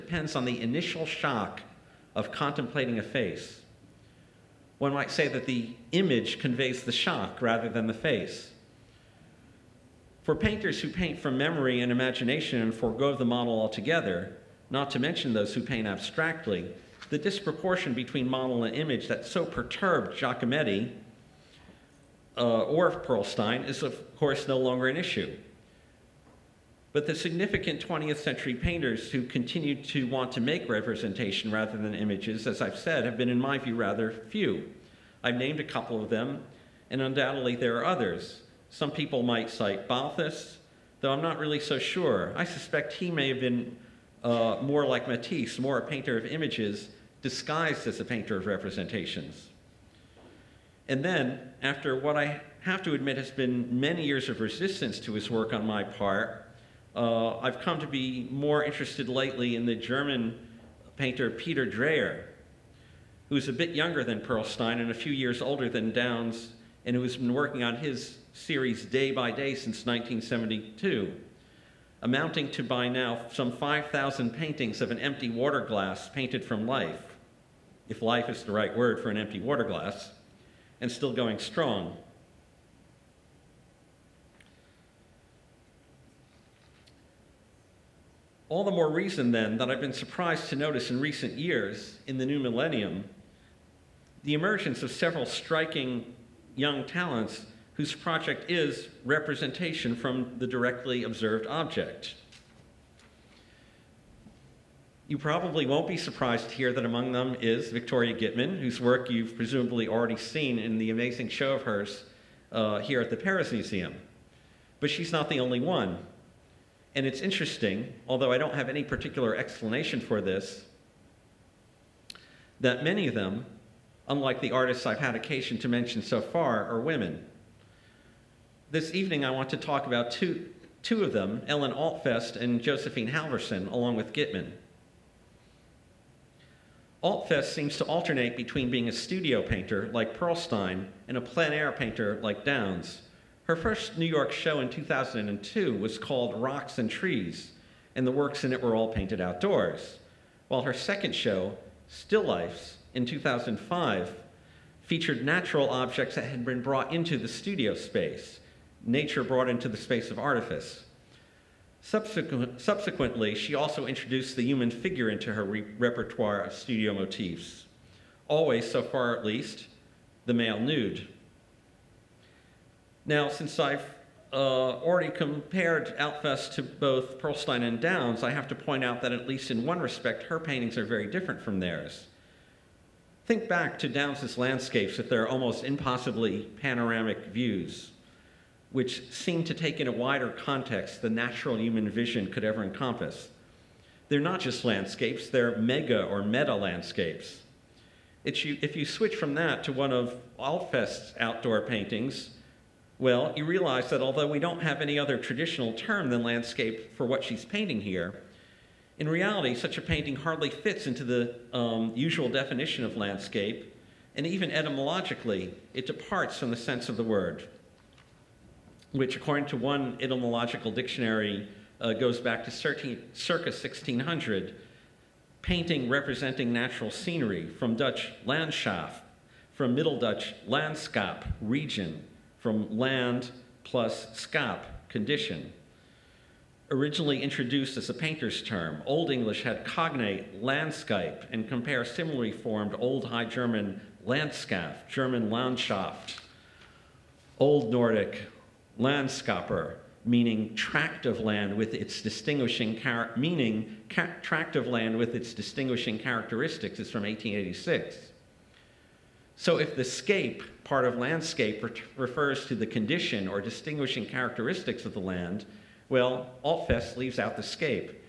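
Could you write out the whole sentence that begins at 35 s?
I've named a couple of them, and undoubtedly there are others.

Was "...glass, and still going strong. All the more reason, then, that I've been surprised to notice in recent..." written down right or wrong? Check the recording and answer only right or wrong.
right.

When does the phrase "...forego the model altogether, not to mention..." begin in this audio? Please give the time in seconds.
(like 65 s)
12 s.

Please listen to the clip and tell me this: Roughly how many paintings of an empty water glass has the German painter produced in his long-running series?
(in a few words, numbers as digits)
5,000.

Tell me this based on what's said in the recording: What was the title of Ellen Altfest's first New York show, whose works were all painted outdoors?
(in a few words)
Rocks and Trees.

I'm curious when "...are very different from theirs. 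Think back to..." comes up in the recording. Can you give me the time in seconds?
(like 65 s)
180 s.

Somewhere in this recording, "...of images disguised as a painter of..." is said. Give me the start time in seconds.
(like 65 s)
46 s.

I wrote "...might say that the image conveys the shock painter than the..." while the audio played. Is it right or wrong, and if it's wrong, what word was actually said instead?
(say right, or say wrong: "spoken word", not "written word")
wrong: "rather", not "painter".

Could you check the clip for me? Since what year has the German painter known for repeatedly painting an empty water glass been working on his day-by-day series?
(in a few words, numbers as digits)
1972.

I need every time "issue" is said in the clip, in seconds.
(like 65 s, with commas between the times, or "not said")
24 s.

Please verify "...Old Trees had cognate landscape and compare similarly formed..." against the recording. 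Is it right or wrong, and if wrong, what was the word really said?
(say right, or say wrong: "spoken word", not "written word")
wrong: "English", not "Trees".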